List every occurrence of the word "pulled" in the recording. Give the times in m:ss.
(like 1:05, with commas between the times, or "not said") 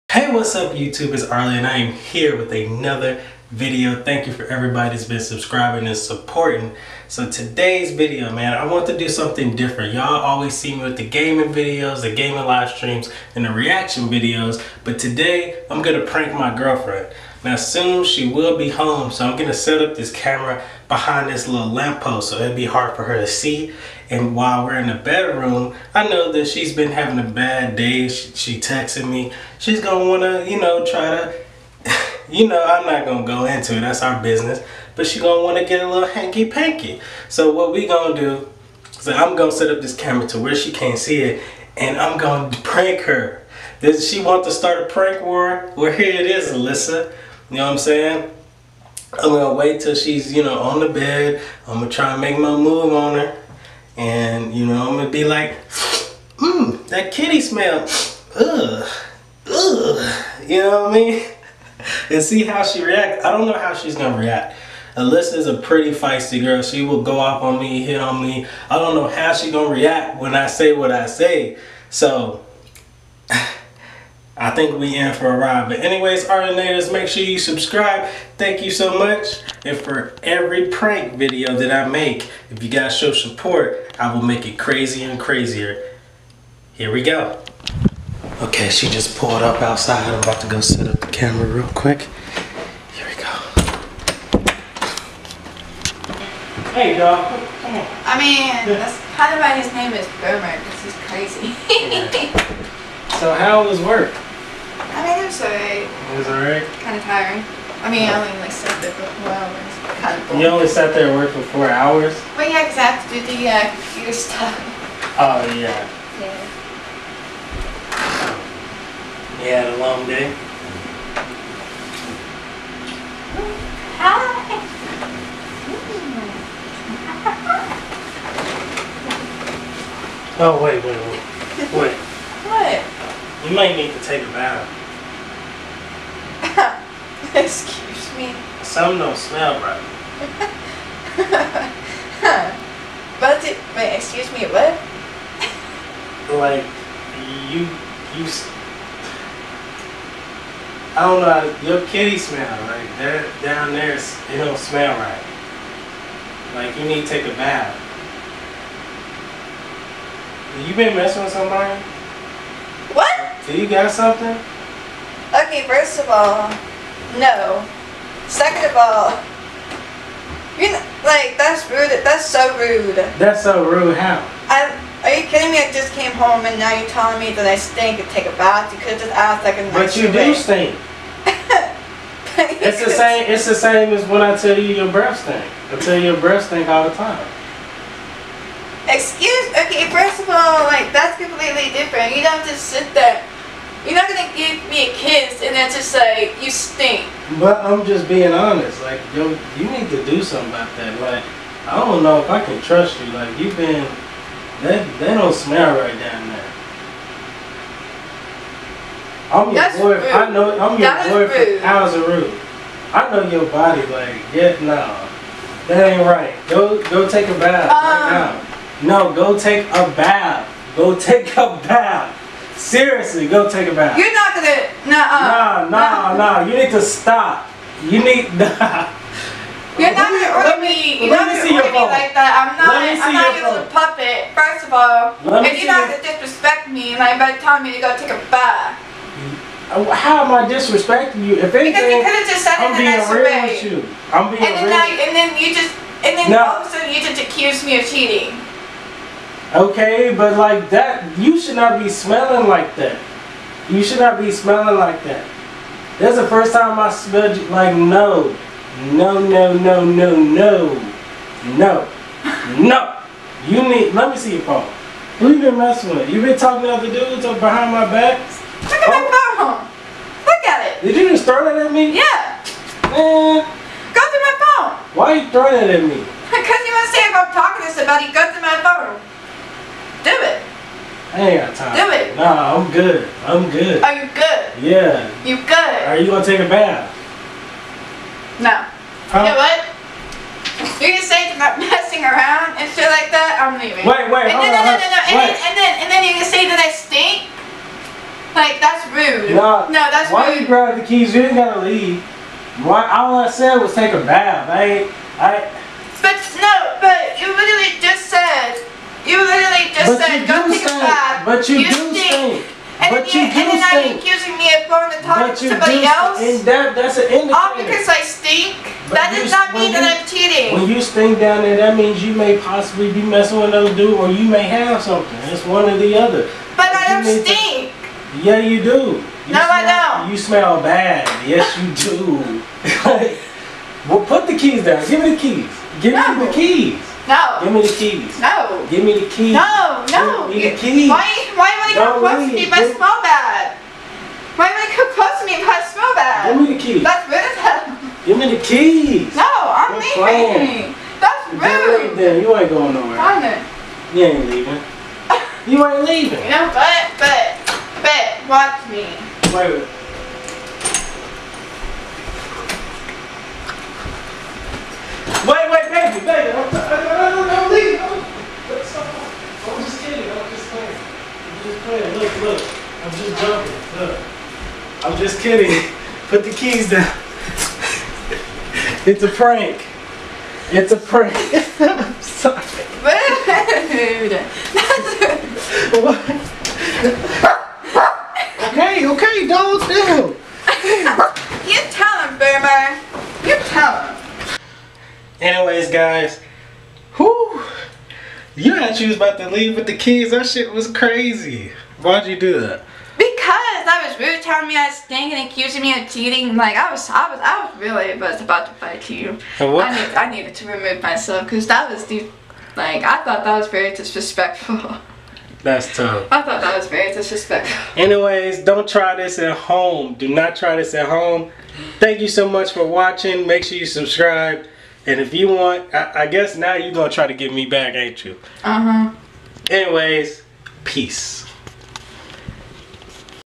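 1:29.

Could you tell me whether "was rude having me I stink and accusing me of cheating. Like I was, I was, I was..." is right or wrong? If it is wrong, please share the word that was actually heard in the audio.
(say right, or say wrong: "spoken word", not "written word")
wrong: "telling", not "having".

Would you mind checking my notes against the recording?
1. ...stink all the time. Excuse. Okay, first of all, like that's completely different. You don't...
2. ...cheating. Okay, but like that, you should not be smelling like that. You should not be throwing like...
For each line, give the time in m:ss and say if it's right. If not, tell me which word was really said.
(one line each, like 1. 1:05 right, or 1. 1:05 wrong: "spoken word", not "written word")
1. 3:06 right
2. 4:07 wrong: "smelling", not "throwing".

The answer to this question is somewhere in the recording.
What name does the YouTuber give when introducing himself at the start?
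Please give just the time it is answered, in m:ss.
0:01.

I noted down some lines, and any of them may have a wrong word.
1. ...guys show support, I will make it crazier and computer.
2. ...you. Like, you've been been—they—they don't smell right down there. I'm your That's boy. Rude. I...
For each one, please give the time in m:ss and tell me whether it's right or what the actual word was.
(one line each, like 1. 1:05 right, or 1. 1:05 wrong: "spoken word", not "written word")
1. 1:22 wrong: "crazier", not "computer"
2. 3:22 right.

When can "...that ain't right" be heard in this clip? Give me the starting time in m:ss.
3:35.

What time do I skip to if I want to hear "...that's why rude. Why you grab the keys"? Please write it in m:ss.
4:59.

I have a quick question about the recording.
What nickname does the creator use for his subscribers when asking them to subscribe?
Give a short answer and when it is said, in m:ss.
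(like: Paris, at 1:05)
Arlinators, at 1:16.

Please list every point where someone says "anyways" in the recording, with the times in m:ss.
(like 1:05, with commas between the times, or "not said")
1:15, 6:35, 6:57, 7:09.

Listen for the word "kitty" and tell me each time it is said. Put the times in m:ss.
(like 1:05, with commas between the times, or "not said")
0:57, 2:31.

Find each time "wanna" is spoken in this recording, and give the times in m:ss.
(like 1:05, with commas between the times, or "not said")
0:30, 0:35.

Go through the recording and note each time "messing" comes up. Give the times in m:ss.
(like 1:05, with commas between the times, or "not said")
2:40, 4:25, 4:51, 5:23.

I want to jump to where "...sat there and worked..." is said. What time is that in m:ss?
1:50.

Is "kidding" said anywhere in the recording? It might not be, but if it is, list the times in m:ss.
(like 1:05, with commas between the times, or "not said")
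2:55, 6:15.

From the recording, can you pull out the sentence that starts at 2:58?
You could just ask like a But you do stink.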